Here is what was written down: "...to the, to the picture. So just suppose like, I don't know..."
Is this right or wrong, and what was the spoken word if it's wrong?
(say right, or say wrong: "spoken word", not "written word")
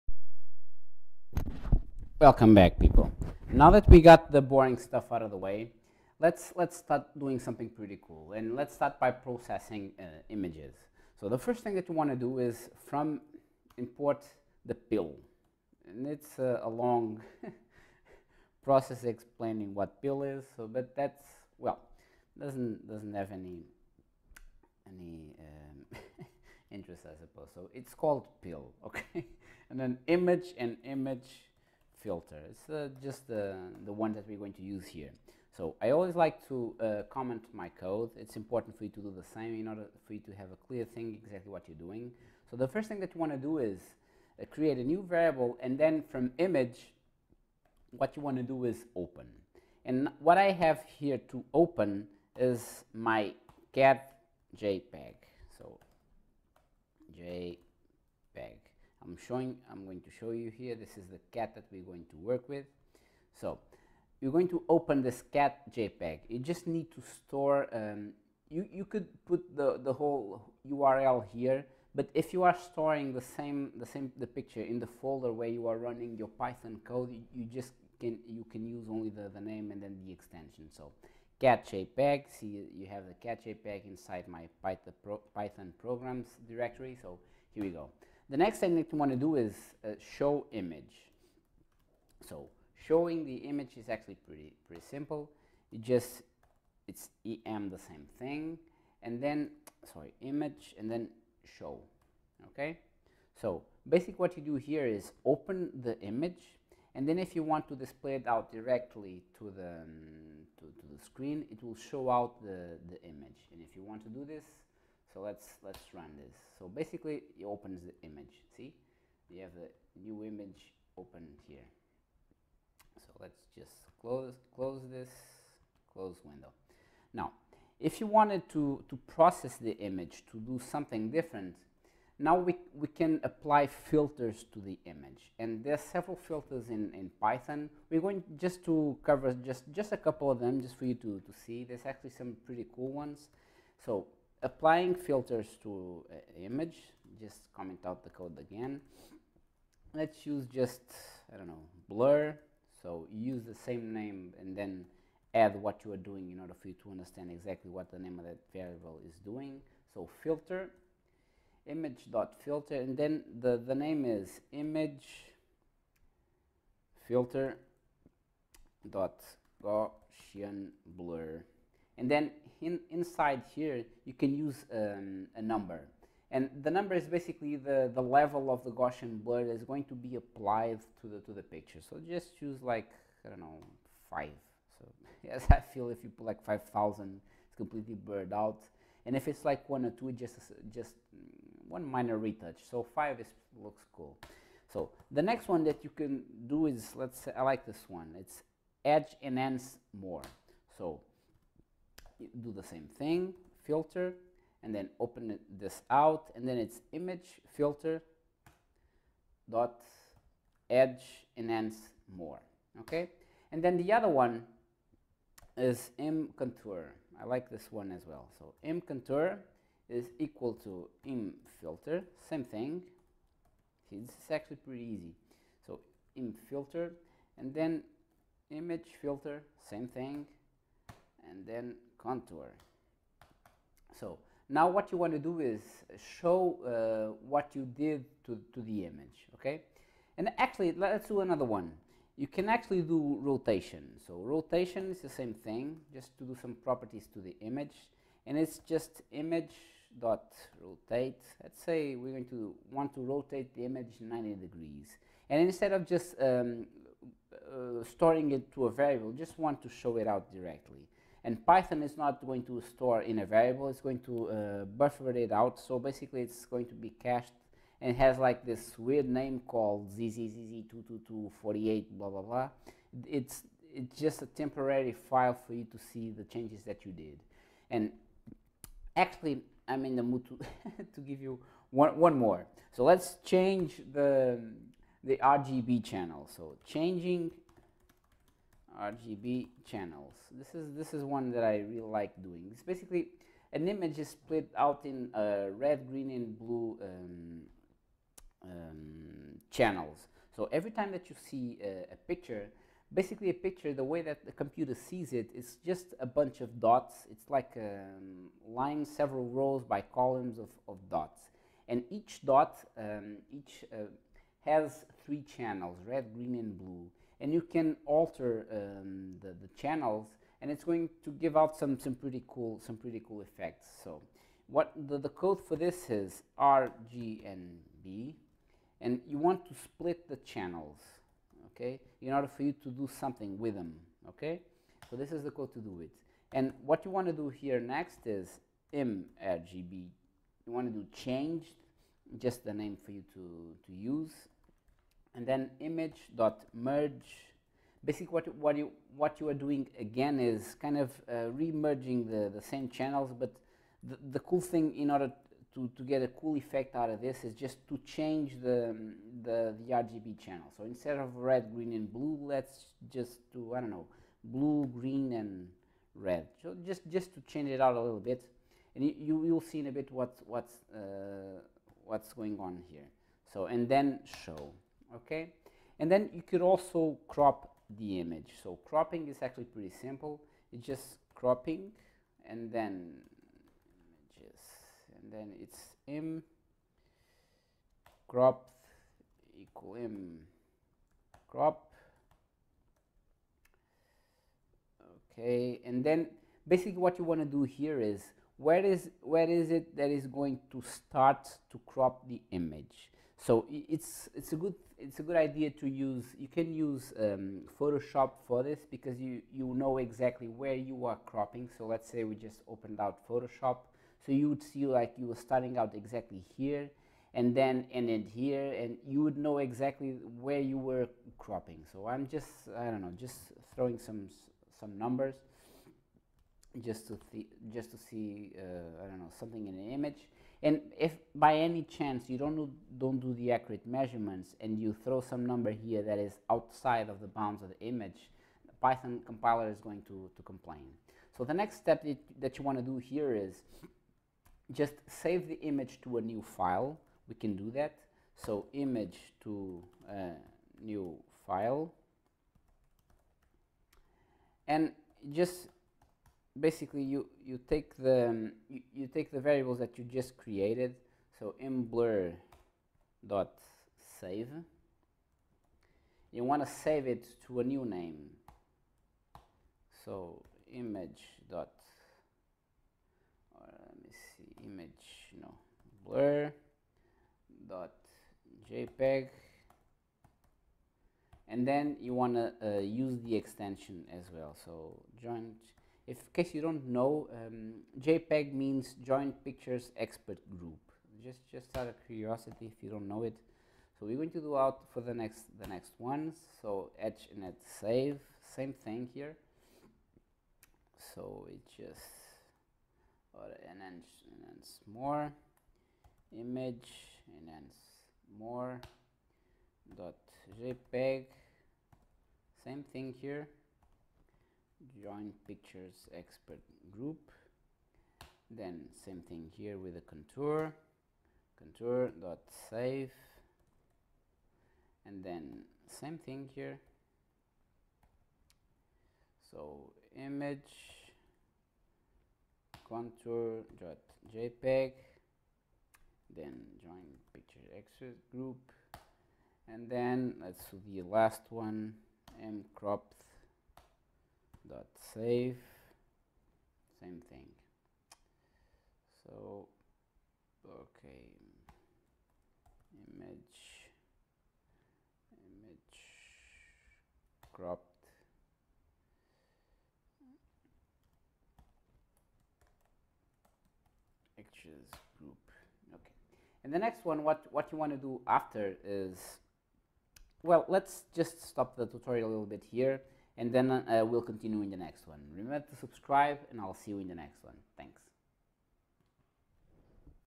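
wrong: "choose", not "suppose".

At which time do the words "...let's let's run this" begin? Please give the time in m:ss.
1:55.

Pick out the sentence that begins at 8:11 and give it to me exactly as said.
Just, just out of curiosity, if you don't know it.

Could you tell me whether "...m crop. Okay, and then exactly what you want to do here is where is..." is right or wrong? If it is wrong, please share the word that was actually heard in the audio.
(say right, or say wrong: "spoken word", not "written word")
wrong: "basically", not "exactly".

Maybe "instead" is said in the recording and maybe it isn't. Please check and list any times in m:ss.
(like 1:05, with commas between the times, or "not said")
4:15, 6:00.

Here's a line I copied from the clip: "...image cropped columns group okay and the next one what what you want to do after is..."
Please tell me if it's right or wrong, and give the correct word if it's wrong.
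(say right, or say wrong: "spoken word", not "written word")
wrong: "actions", not "columns".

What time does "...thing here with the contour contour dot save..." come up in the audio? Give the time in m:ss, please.
8:39.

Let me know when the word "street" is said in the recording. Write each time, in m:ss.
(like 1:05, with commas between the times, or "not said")
not said.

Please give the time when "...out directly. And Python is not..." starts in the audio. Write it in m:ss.
4:20.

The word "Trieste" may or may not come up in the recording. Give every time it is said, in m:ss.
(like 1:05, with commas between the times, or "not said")
not said.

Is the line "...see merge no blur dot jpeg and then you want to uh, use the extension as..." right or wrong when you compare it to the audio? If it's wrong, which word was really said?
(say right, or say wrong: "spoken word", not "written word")
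wrong: "image", not "merge".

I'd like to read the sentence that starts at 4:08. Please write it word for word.
And it's just image dot rotate.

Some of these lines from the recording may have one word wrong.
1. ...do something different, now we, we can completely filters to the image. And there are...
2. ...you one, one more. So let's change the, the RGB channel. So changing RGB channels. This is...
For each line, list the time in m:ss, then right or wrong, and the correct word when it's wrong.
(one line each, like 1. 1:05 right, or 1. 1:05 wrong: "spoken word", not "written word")
1. 2:10 wrong: "apply", not "completely"
2. 4:41 right.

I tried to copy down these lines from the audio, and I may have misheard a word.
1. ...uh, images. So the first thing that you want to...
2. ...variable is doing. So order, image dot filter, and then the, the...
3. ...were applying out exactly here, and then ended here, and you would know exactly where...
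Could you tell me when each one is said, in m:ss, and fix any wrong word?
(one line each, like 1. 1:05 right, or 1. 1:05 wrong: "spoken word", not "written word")
1. 0:09 right
2. 2:38 wrong: "filter", not "order"
3. 6:55 wrong: "starting", not "applying".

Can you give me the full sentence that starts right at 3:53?
So now what you want to do is show uh, what you did to, to the image, okay?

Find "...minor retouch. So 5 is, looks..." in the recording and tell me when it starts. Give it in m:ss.
3:11.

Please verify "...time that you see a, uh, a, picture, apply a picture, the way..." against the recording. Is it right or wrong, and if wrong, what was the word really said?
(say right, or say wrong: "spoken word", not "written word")
wrong: "basically", not "apply".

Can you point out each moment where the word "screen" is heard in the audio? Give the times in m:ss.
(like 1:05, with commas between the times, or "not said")
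1:51.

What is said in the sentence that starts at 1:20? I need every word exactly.
So cat JPEG, see you have the cat JPEG inside my Python, pro, Python programs directory.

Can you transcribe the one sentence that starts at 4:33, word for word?
It's, it's just a temporary file for you to see the changes that you did.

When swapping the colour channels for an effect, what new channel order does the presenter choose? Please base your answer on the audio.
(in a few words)
blue, green, and red.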